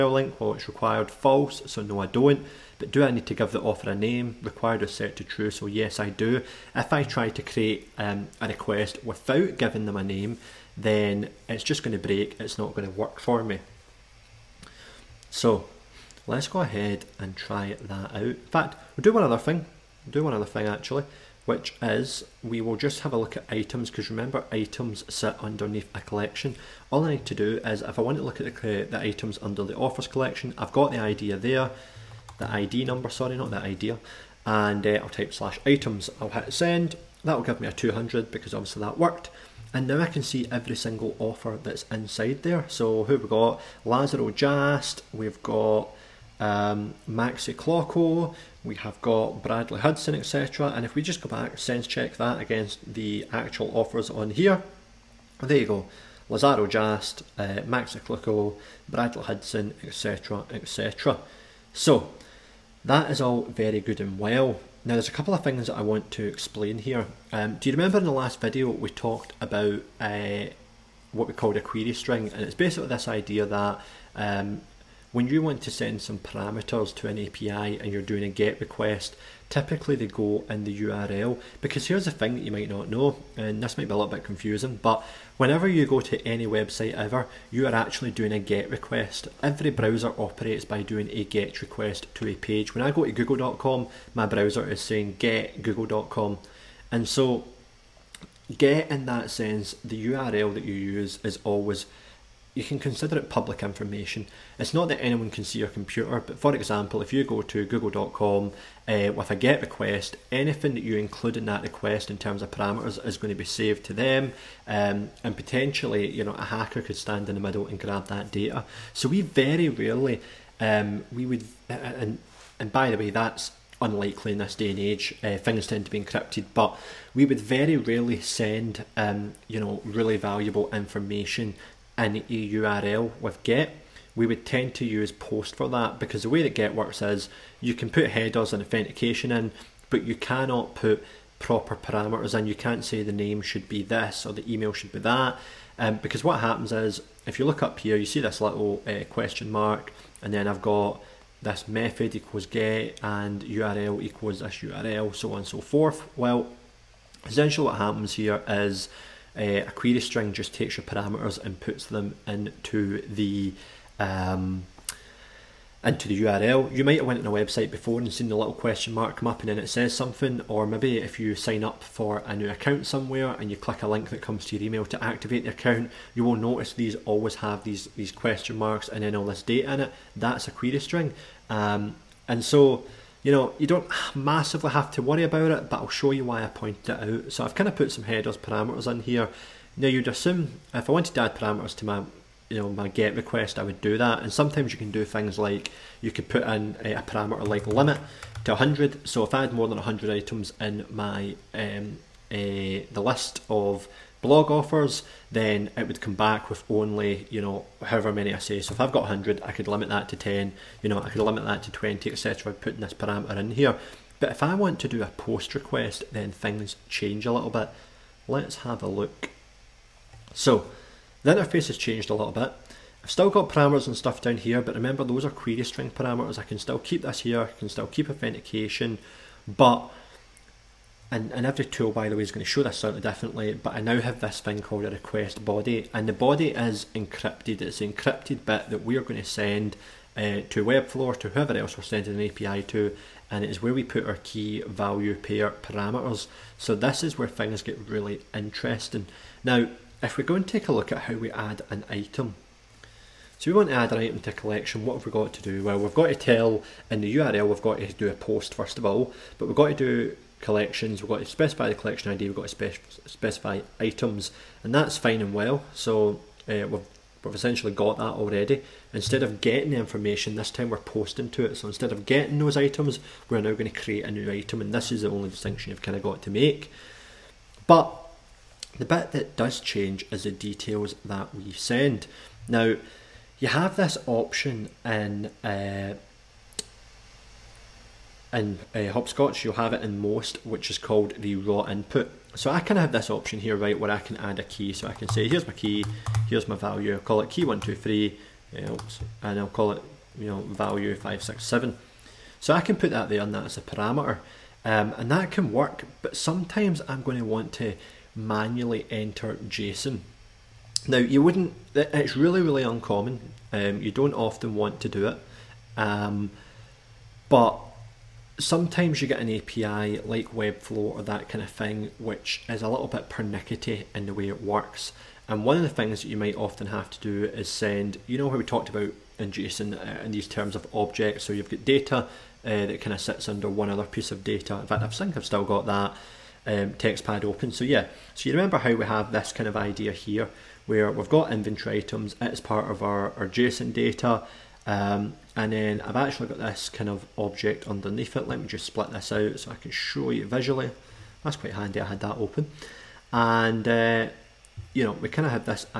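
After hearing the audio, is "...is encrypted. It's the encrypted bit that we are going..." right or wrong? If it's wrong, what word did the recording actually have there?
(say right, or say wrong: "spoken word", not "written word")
right.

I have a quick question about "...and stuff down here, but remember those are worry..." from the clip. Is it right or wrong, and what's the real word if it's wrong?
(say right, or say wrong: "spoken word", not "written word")
wrong: "query", not "worry".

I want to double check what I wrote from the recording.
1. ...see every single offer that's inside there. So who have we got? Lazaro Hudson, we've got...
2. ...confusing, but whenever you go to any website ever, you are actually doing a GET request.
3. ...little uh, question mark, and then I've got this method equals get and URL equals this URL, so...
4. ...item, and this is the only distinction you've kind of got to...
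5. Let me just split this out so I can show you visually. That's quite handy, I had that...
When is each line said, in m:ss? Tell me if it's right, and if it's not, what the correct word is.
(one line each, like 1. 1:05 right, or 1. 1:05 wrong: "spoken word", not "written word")
1. 0:40 wrong: "Jast", not "Hudson"
2. 1:24 right
3. 2:28 right
4. 4:34 right
5. 5:48 right.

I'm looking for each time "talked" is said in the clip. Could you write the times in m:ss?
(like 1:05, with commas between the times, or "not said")
1:08, 5:28.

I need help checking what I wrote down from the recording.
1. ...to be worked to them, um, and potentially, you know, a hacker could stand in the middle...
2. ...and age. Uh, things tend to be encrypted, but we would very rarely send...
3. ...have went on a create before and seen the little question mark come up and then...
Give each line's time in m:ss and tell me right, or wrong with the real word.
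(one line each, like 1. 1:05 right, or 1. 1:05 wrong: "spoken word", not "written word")
1. 1:53 wrong: "saved", not "worked"
2. 2:04 right
3. 2:46 wrong: "website", not "create".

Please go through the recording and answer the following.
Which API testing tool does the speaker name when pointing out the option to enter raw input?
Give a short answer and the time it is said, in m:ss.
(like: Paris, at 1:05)
Hoppscotch, at 4:48.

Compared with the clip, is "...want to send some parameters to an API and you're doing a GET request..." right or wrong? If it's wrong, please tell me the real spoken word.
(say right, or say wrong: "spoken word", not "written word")
right.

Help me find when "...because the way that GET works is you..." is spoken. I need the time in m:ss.
2:15.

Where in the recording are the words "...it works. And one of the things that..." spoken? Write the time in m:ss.
5:24.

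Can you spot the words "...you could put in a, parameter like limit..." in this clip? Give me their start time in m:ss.
3:16.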